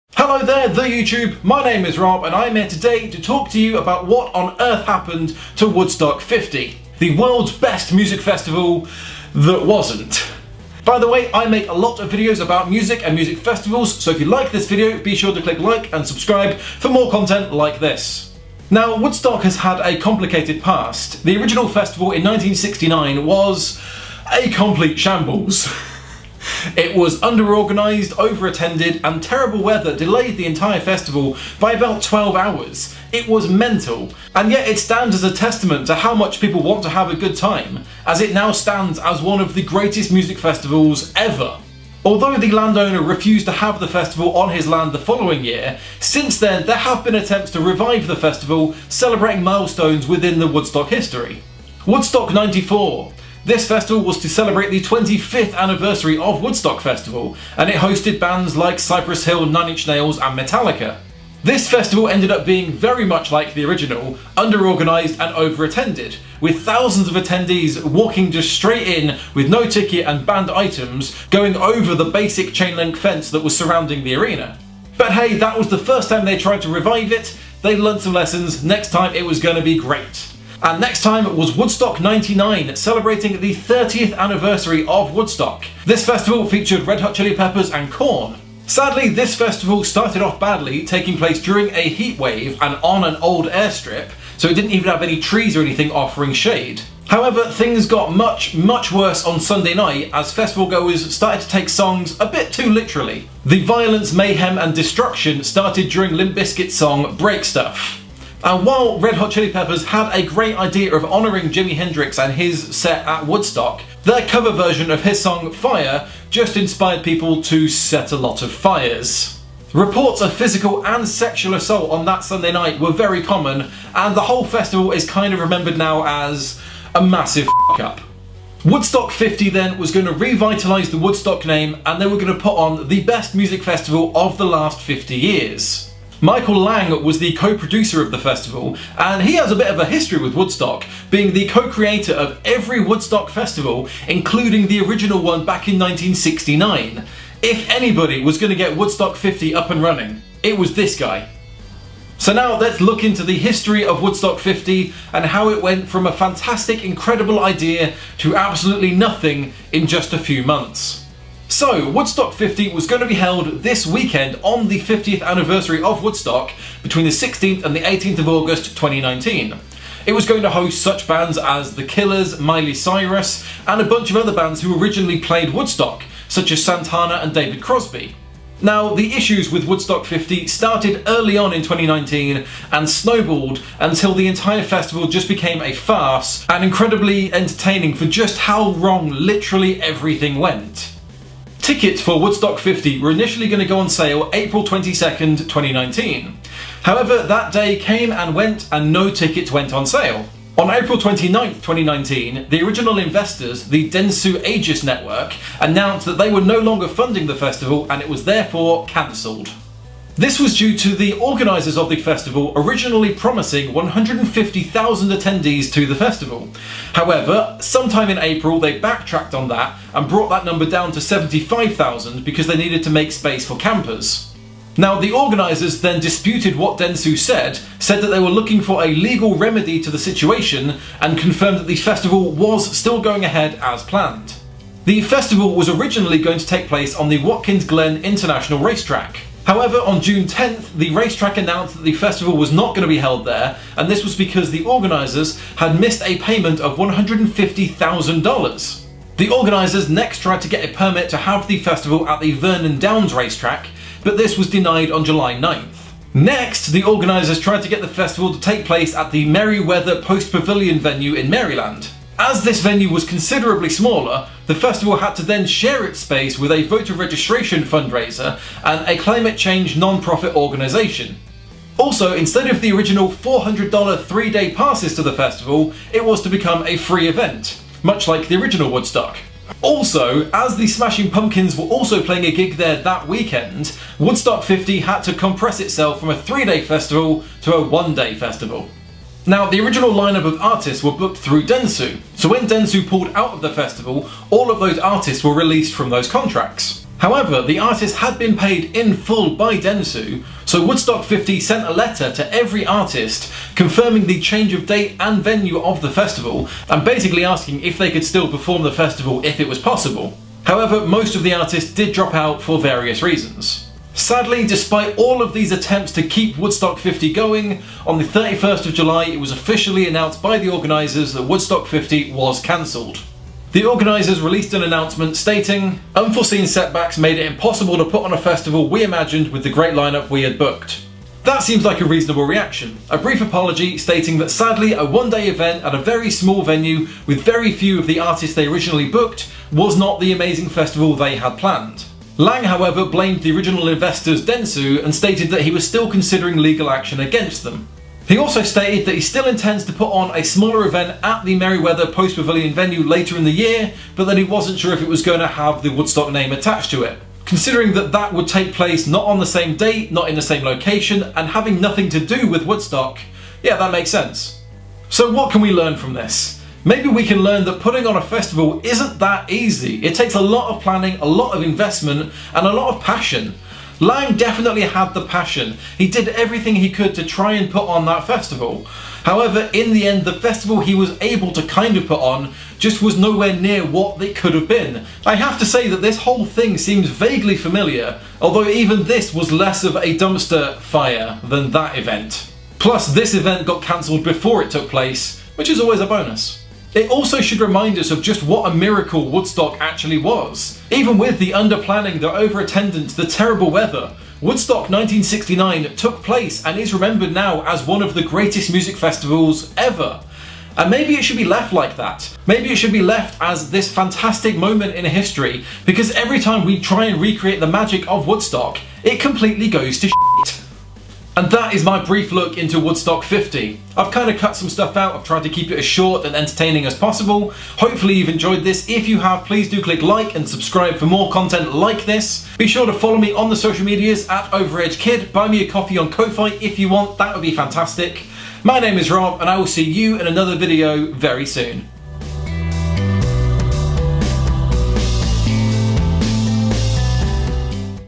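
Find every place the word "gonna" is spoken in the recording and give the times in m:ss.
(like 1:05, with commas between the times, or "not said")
not said.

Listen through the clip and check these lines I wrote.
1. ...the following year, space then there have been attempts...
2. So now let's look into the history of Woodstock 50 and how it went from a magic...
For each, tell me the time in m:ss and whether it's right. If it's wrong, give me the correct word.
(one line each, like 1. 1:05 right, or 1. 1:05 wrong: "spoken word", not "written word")
1. 0:44 wrong: "since", not "space"
2. 2:32 wrong: "fantastic", not "magic".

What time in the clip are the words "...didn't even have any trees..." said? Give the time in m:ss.
1:34.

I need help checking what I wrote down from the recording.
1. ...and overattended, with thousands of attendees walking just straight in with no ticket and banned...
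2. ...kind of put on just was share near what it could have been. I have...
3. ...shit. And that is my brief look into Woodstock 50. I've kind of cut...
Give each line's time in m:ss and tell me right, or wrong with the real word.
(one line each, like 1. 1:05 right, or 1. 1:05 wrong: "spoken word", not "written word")
1. 1:05 right
2. 6:21 wrong: "nowhere", not "share"
3. 6:59 right.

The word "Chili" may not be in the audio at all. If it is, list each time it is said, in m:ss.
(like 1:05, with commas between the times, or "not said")
1:27, 1:49.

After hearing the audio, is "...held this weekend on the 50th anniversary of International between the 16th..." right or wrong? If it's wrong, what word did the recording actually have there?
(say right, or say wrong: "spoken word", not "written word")
wrong: "Woodstock", not "International".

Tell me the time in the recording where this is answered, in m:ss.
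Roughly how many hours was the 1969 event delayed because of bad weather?
0:32.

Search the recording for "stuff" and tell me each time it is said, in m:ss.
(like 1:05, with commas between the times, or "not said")
1:47, 7:04.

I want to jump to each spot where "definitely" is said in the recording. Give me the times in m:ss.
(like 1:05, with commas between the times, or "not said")
6:14.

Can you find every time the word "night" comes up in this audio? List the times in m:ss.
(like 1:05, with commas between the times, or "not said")
1:39, 2:02.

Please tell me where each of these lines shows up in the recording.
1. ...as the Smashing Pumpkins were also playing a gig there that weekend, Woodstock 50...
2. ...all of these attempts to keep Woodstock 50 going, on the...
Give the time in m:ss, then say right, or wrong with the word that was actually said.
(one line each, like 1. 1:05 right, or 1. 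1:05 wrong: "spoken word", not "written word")
1. 4:40 right
2. 5:14 right.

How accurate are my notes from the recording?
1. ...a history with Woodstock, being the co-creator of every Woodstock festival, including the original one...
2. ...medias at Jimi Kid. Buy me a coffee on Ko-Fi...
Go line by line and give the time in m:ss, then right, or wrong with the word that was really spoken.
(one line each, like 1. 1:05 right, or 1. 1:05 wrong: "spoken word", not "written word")
1. 2:19 right
2. 7:13 wrong: "Overage", not "Jimi".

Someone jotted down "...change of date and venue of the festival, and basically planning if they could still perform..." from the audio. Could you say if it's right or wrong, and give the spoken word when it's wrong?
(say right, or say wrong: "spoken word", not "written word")
wrong: "asking", not "planning".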